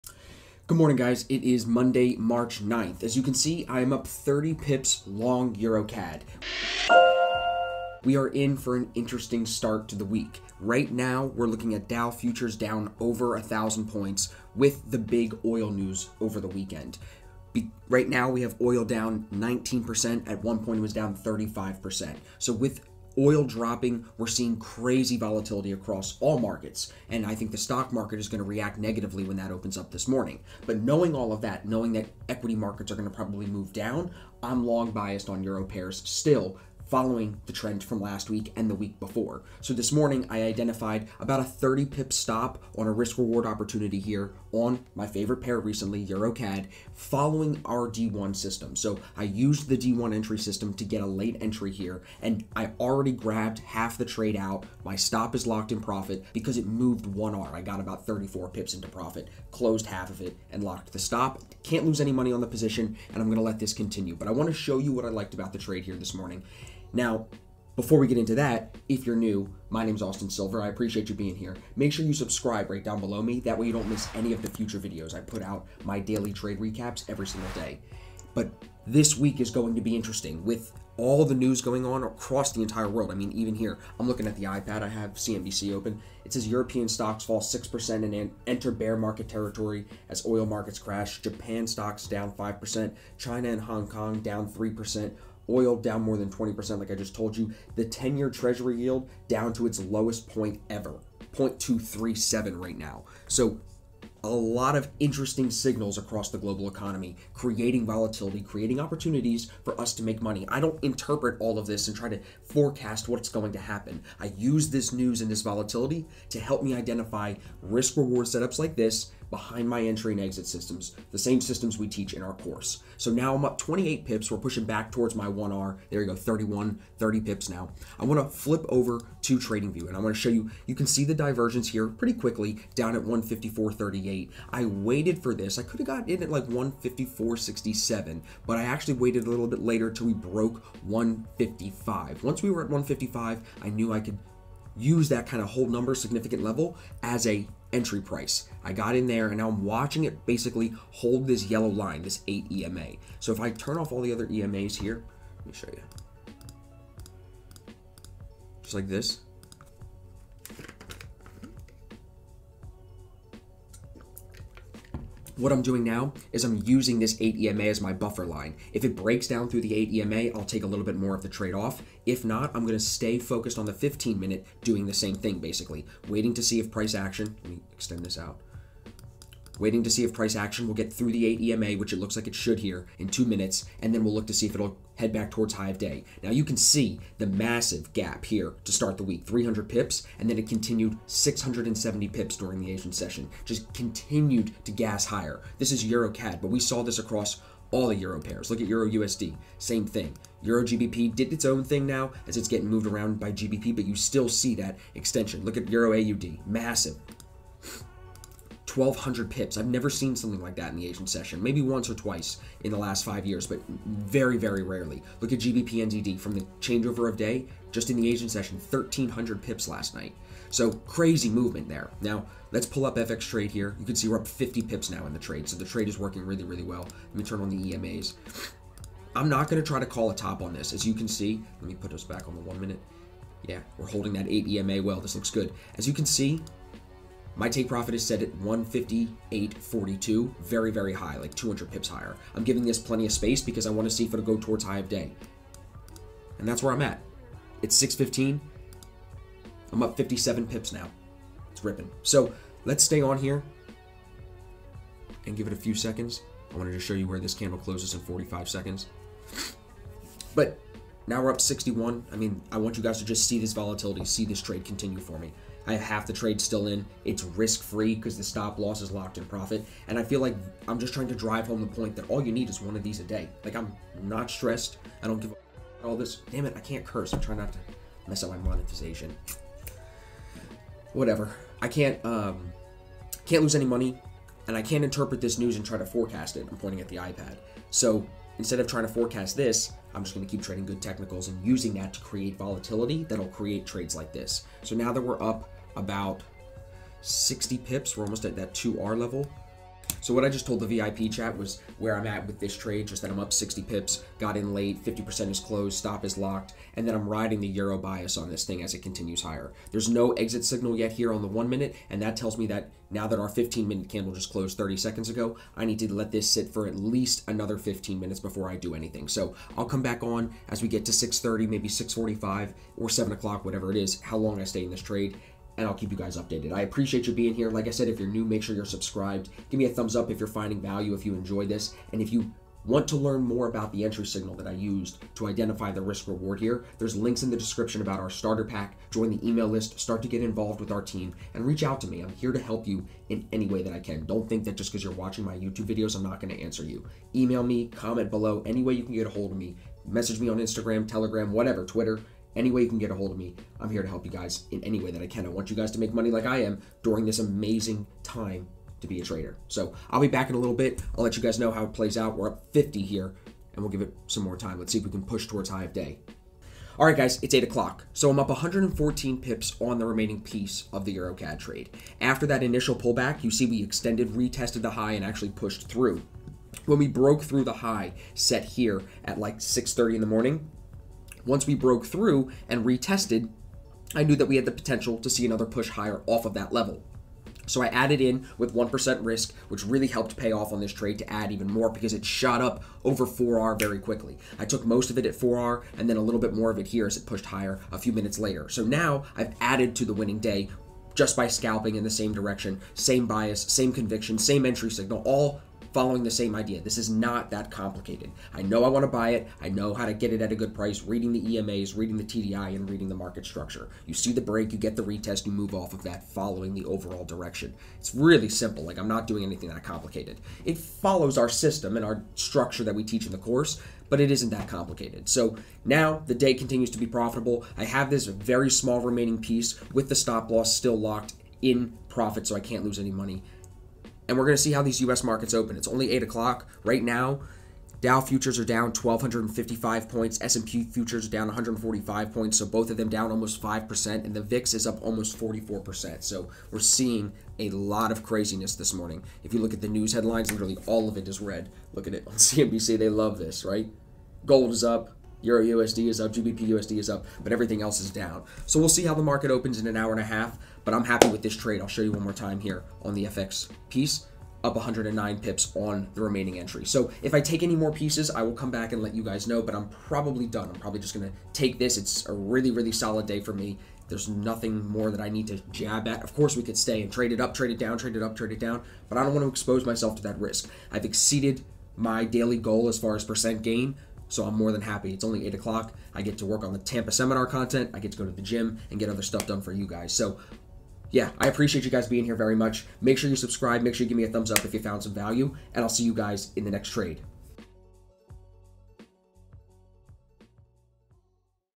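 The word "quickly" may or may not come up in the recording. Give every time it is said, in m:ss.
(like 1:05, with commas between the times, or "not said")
2:12, 6:33.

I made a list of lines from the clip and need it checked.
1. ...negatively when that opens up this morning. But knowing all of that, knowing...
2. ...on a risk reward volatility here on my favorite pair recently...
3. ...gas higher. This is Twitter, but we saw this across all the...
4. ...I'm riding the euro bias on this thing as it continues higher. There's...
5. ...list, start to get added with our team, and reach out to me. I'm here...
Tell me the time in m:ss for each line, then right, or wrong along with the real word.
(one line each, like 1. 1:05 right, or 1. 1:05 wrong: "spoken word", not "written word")
1. 0:28 right
2. 0:42 wrong: "opportunity", not "volatility"
3. 3:14 wrong: "EuroCAD", not "Twitter"
4. 5:06 right
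5. 5:39 wrong: "involved", not "added".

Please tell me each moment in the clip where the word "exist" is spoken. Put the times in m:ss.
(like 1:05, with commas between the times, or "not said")
not said.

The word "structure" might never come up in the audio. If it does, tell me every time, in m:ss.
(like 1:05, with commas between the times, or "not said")
6:53, 7:02.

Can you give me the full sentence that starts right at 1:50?
I don't interpret all of this and try to forecast what's going to happen.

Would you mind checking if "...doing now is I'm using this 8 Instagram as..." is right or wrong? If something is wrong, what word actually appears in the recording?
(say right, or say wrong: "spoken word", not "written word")
wrong: "EMA", not "Instagram".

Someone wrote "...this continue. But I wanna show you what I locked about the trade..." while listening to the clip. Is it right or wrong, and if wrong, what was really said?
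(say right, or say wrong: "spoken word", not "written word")
wrong: "liked", not "locked".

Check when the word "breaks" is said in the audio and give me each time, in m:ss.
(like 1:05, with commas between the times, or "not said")
2:48, 6:54.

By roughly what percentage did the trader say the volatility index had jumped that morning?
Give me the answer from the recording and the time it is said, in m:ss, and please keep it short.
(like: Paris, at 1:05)
44%, at 7:25.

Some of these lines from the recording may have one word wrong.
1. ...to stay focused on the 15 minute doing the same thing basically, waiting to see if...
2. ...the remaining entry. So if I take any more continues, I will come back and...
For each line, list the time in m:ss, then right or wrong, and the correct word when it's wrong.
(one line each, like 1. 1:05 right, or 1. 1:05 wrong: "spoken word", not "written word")
1. 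2:52 right
2. 7:45 wrong: "pieces", not "continues".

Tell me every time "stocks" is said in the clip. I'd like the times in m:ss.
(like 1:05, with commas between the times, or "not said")
0:27, 1:26, 1:31.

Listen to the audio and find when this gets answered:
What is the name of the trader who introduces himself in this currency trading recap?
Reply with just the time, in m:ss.
1:10.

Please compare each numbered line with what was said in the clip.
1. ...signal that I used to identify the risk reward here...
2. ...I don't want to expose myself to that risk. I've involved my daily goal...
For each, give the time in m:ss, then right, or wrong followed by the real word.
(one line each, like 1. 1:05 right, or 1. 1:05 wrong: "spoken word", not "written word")
1. 5:34 right
2. 7:58 wrong: "exceeded", not "involved".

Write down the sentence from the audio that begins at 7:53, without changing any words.
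There's nothing more that I need to jab at.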